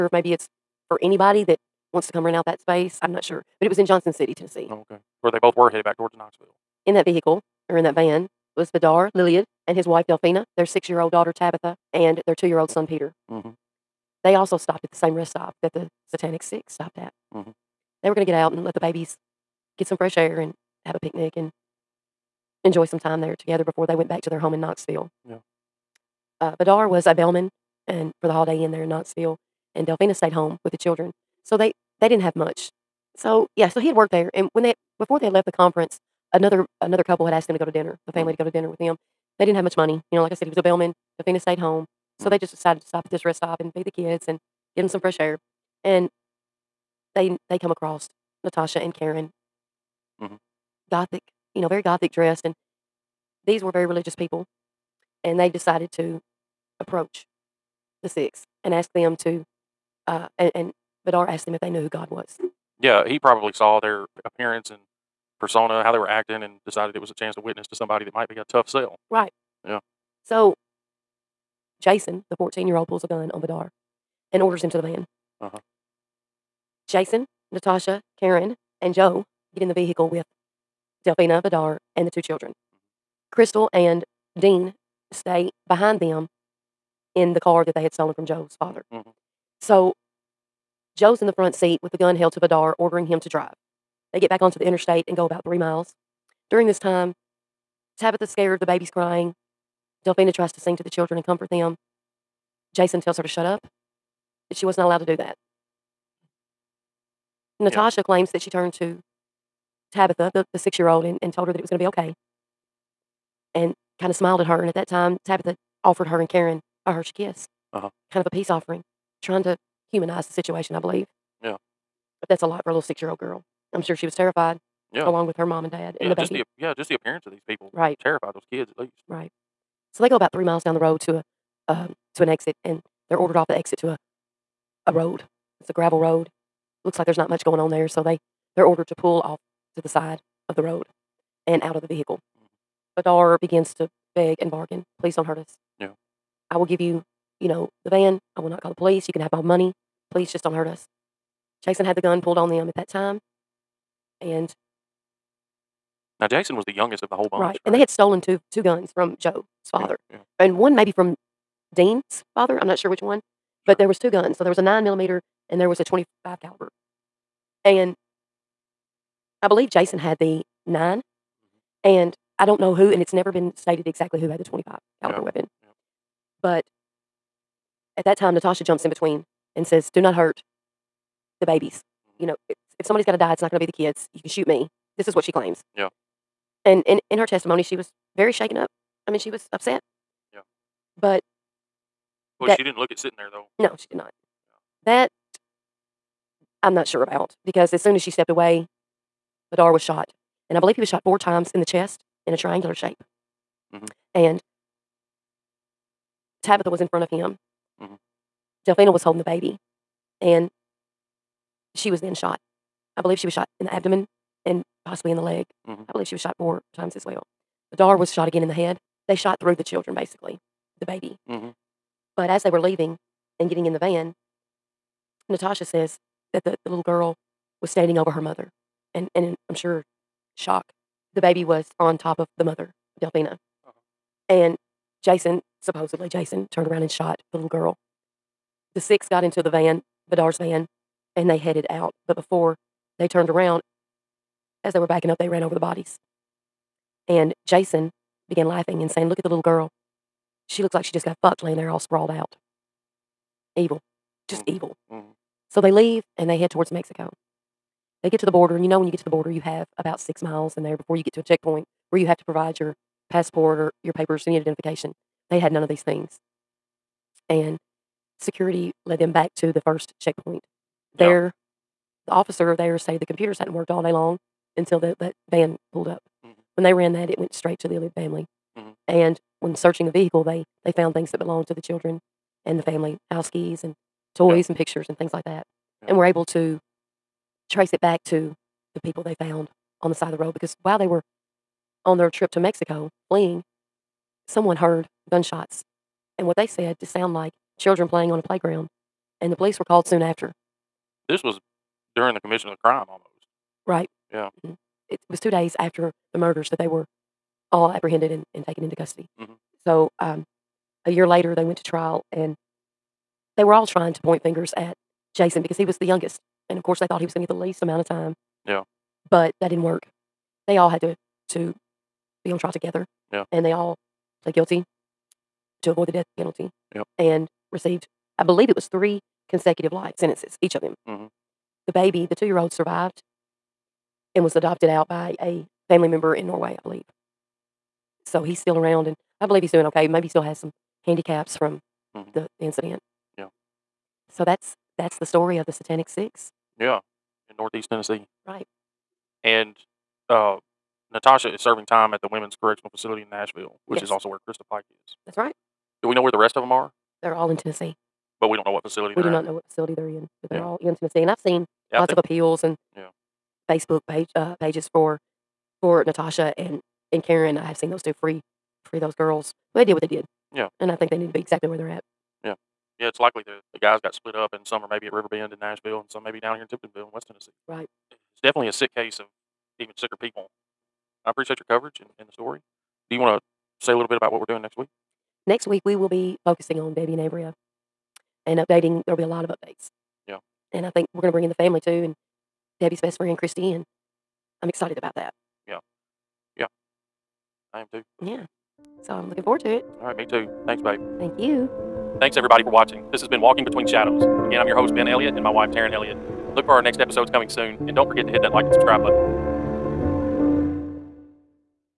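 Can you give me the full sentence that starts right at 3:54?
and Jason supposedly Jason turned around and shot the little girl.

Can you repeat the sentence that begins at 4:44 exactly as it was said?
and pictures and things like that.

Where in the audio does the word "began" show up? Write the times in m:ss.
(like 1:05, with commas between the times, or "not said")
4:08.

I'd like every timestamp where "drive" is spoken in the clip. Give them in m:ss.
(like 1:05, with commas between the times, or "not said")
1:33.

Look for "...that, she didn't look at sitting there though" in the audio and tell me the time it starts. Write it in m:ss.
3:12.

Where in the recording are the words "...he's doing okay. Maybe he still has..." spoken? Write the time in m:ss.
5:39.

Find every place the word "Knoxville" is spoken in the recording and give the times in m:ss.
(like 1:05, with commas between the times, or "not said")
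0:06, 0:24, 0:28.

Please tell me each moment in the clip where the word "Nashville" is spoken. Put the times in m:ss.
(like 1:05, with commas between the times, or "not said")
5:53, 6:15.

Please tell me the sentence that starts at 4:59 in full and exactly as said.
And the police were called soon after.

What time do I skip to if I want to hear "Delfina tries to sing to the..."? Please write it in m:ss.
1:40.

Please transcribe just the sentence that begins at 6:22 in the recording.
Do you want to say a little bit about what we're doing next week?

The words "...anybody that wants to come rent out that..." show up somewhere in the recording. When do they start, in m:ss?
0:01.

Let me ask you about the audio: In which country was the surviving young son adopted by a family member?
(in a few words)
Norway.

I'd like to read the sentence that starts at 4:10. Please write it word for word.
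She looks like she just got fucked laying there all sprawled out.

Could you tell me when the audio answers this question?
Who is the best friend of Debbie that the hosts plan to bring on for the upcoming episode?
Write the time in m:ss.
6:33.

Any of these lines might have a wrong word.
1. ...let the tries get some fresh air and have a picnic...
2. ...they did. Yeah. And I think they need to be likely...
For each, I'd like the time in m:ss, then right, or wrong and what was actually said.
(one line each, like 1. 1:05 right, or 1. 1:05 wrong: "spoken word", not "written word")
1. 0:18 wrong: "babies", not "tries"
2. 6:09 wrong: "exactly", not "likely".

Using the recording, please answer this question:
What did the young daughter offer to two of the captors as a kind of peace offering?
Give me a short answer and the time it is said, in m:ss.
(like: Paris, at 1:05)
A Hershey Kiss, at 1:56.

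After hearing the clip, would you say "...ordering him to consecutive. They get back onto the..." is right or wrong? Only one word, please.
wrong.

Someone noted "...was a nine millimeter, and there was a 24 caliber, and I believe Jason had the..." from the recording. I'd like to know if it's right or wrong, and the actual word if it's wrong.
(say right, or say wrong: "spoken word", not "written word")
wrong: "25", not "24".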